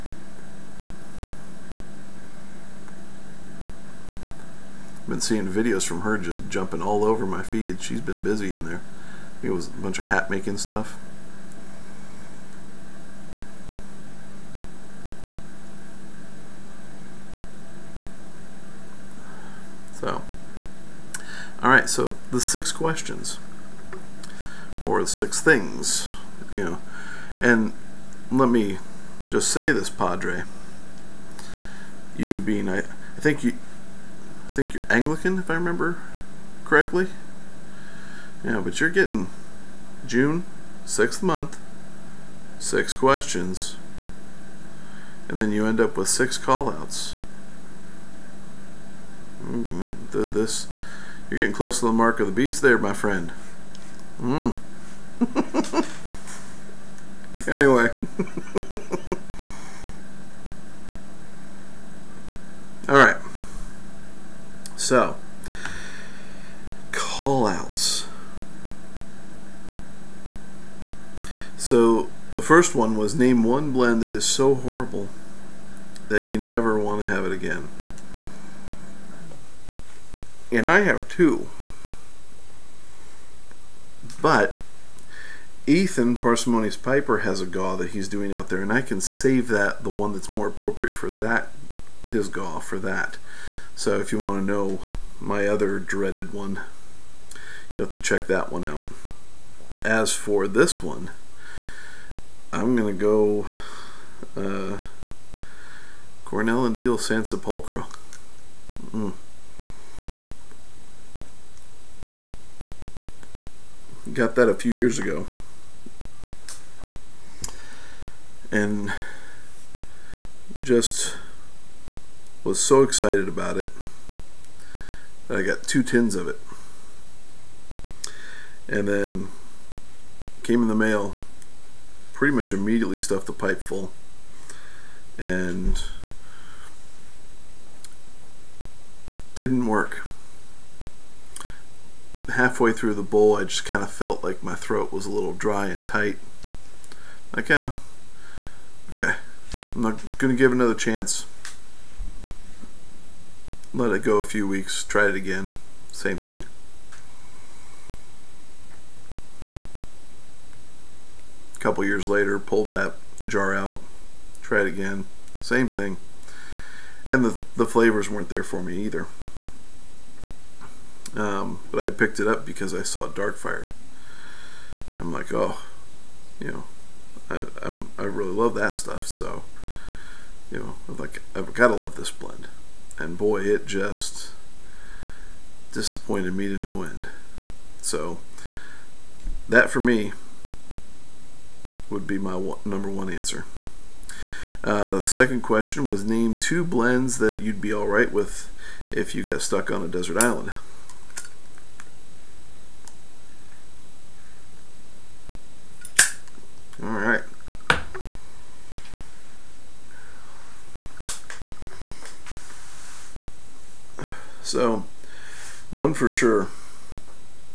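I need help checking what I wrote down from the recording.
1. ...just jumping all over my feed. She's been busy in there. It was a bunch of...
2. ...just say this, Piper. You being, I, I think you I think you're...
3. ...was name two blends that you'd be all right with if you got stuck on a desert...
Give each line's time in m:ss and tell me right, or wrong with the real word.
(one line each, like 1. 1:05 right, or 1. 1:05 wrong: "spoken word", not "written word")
1. 0:06 right
2. 0:29 wrong: "Padre", not "Piper"
3. 3:15 right.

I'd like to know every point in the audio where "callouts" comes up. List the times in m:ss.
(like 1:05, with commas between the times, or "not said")
0:46, 1:06.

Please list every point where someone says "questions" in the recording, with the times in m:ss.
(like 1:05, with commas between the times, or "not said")
0:22, 0:42, 3:15.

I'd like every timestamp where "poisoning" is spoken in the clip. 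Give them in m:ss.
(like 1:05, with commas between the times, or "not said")
not said.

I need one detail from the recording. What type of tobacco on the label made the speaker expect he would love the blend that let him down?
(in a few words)
Dark fired.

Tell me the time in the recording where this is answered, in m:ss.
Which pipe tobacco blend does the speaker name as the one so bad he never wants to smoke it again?
1:46.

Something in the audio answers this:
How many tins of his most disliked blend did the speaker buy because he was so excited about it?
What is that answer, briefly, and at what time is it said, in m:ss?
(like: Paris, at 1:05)
2, at 2:05.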